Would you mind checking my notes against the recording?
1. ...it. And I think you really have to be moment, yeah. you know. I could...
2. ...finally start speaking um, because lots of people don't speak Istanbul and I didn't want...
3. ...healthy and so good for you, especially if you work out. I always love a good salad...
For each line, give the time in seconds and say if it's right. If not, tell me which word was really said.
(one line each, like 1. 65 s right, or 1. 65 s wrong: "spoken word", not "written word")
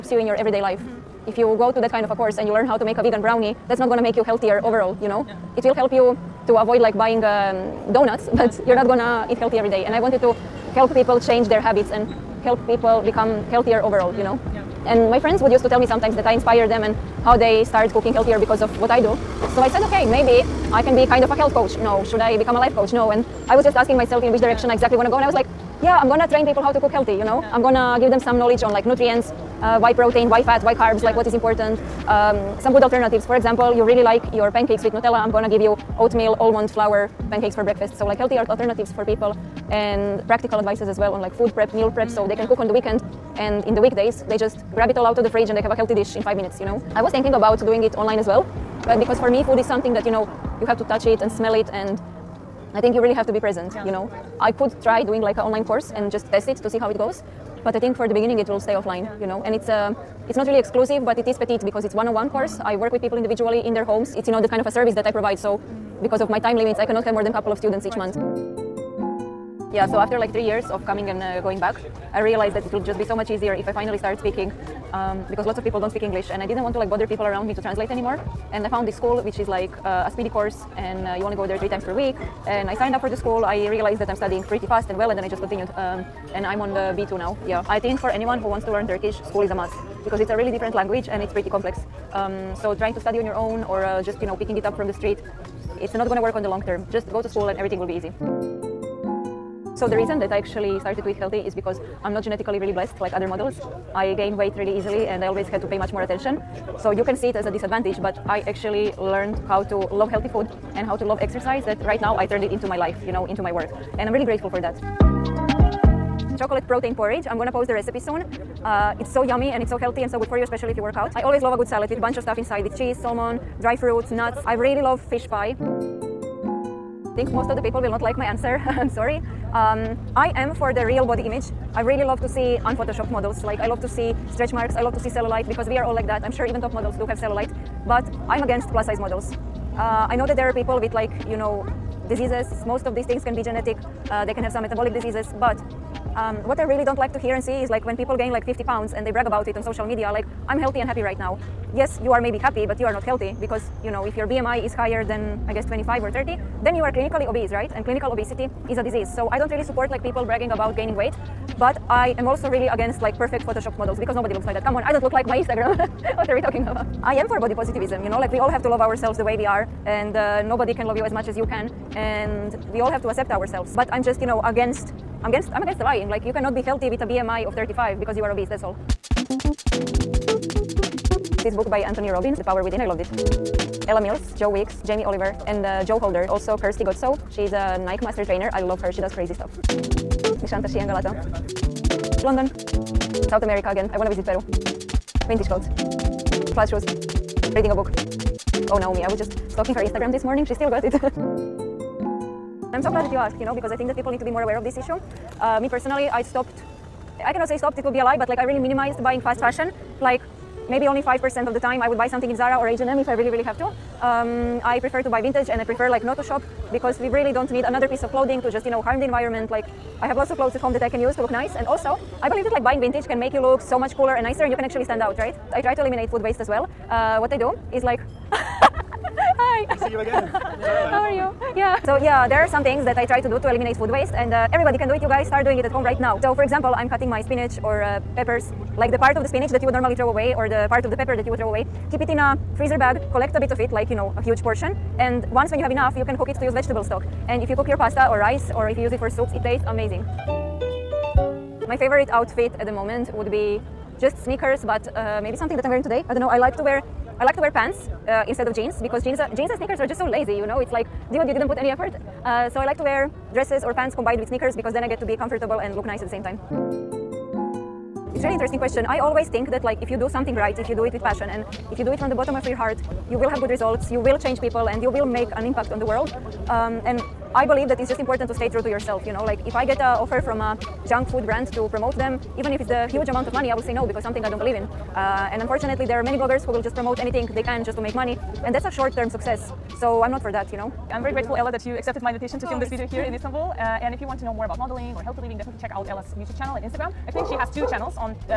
1. 51 s wrong: "present", not "moment"
2. 73 s wrong: "English", not "Istanbul"
3. 119 s right.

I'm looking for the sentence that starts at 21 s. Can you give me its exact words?
No, should I become a life coach?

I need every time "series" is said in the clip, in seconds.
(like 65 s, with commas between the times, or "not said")
not said.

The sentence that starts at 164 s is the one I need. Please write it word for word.
Come on, I don't look like my Instagram.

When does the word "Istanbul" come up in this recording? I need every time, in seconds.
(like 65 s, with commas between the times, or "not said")
293 s.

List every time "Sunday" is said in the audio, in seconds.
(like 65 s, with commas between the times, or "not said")
not said.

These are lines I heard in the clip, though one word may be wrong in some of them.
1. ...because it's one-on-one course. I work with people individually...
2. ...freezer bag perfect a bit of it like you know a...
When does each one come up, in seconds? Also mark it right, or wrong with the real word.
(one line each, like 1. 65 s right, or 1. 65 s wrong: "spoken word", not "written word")
1. 61 s right
2. 242 s wrong: "collect", not "perfect".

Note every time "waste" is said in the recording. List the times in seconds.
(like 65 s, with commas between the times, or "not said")
226 s, 233 s.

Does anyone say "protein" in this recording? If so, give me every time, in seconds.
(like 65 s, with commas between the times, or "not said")
29 s, 116 s.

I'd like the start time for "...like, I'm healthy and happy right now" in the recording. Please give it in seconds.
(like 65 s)
150 s.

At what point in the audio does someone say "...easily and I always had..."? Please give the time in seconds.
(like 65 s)
104 s.